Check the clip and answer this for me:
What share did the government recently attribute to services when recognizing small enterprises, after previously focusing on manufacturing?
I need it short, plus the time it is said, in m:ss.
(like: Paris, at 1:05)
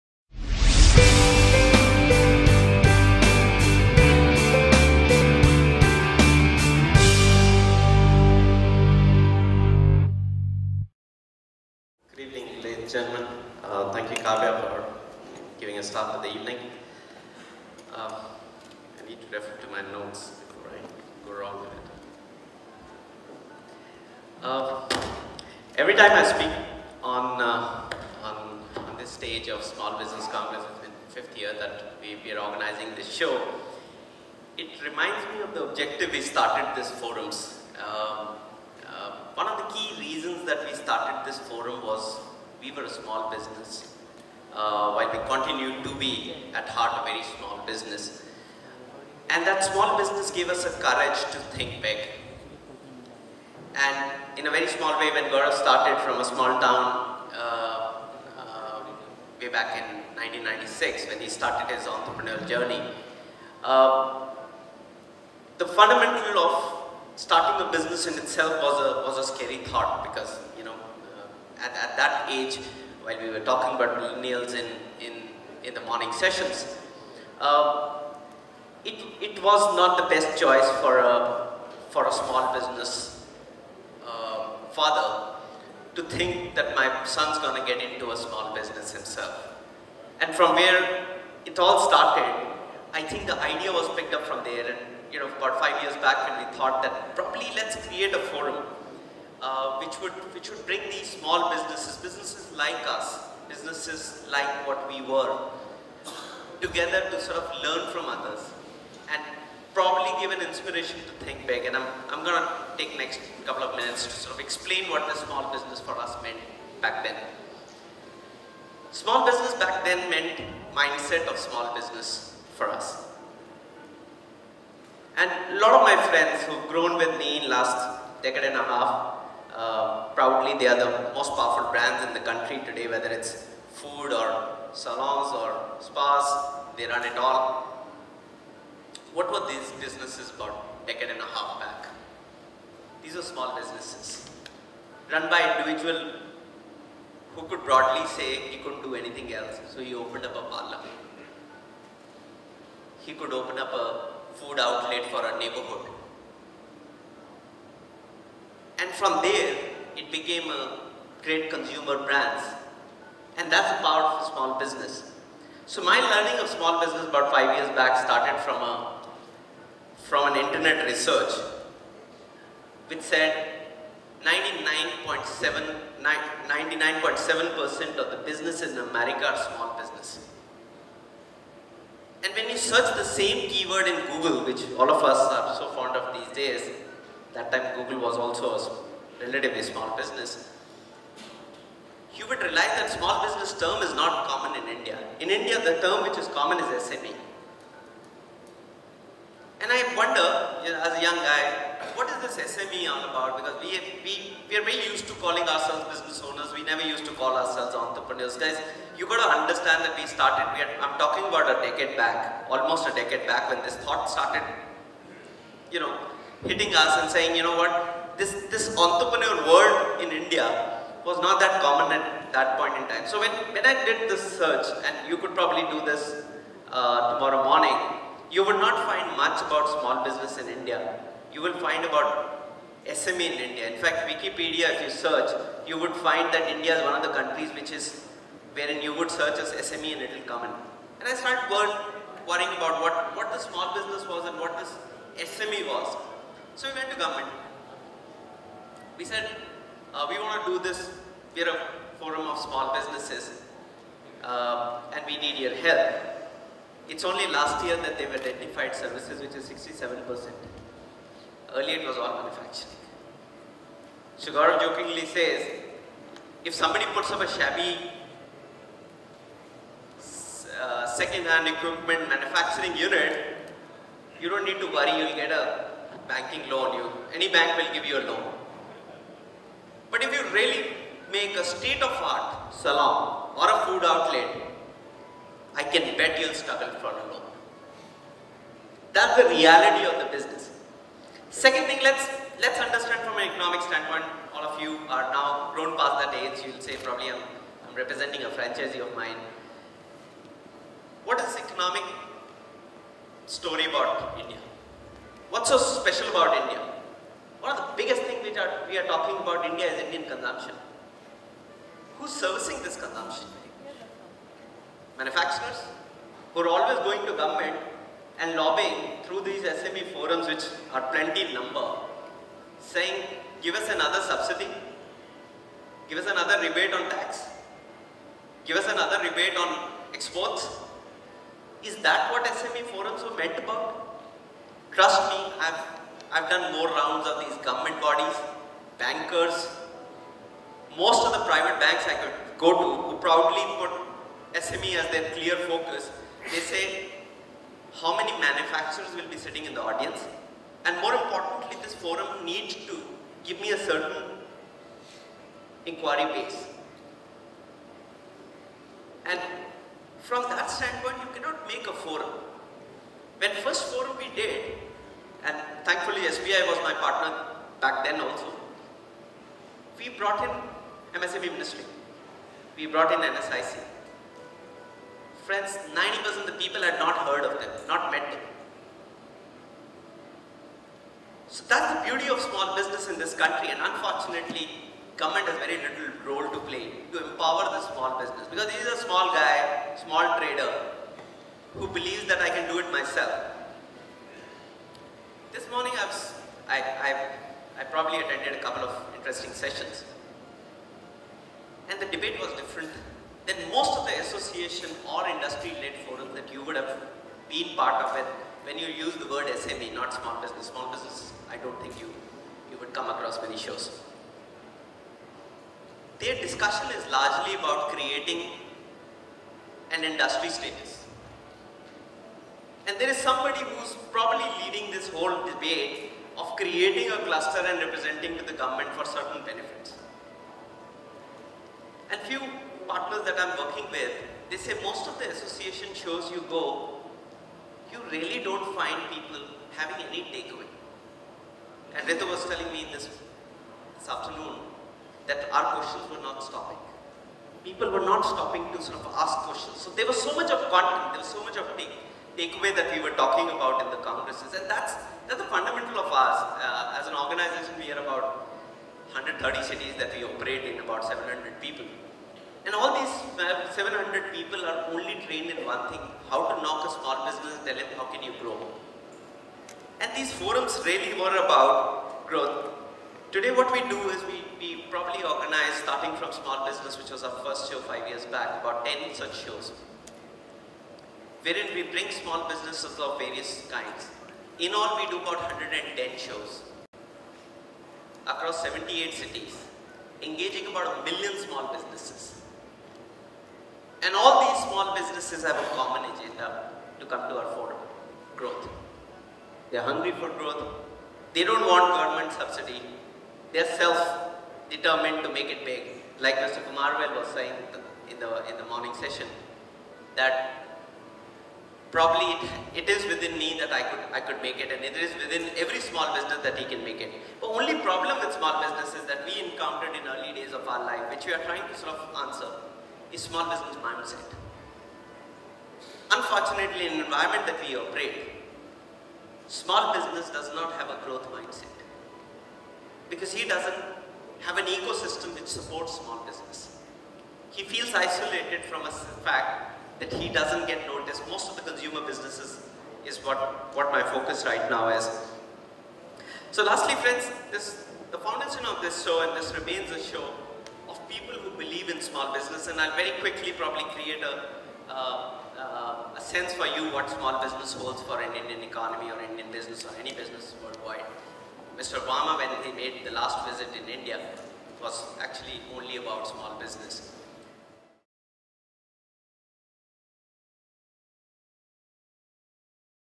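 67%, at 4:19.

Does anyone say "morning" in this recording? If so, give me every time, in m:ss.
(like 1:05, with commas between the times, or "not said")
1:15, 3:47, 6:35, 8:28.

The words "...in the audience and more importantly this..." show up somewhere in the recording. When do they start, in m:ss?
5:49.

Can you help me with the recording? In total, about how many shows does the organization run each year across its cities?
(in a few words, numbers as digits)
110.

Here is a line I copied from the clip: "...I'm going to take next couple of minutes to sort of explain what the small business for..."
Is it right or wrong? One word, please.
right.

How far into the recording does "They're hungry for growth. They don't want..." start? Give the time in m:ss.
8:19.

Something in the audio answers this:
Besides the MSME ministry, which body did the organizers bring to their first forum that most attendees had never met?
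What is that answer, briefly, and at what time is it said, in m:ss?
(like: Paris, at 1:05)
NSIC, at 6:12.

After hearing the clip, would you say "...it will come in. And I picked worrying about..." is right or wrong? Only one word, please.
wrong.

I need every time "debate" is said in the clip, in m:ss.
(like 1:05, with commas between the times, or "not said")
6:41, 7:05.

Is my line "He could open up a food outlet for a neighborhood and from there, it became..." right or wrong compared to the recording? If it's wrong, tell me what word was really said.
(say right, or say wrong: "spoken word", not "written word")
right.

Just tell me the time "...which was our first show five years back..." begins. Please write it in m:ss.
7:56.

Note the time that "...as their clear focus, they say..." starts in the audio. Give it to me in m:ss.
5:44.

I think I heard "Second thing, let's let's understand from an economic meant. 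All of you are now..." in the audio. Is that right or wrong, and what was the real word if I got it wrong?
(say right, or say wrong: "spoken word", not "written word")
wrong: "standpoint", not "meant".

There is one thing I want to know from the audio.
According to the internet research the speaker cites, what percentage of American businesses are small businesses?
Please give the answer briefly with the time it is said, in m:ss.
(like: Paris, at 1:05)
99.7%, at 2:54.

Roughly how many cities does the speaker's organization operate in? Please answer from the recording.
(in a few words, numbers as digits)
130.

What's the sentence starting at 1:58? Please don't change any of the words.
Small business back then meant mindset of small business for us.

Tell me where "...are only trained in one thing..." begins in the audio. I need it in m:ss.
7:44.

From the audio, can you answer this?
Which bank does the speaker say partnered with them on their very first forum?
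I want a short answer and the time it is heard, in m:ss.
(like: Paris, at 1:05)
SBI, at 6:06.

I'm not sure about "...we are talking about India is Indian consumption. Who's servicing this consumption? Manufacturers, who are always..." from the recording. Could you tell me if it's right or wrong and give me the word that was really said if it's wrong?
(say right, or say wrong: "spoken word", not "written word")
right.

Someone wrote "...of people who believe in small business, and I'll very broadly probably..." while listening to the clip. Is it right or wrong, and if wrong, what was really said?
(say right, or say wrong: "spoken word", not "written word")
wrong: "quickly", not "broadly".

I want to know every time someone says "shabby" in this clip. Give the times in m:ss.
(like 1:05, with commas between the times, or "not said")
4:27.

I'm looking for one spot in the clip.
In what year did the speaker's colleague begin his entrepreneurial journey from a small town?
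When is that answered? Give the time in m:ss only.
1:00.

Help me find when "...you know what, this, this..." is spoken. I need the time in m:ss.
3:37.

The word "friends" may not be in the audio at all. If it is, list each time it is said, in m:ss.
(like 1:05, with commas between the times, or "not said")
2:06, 6:15, 9:06.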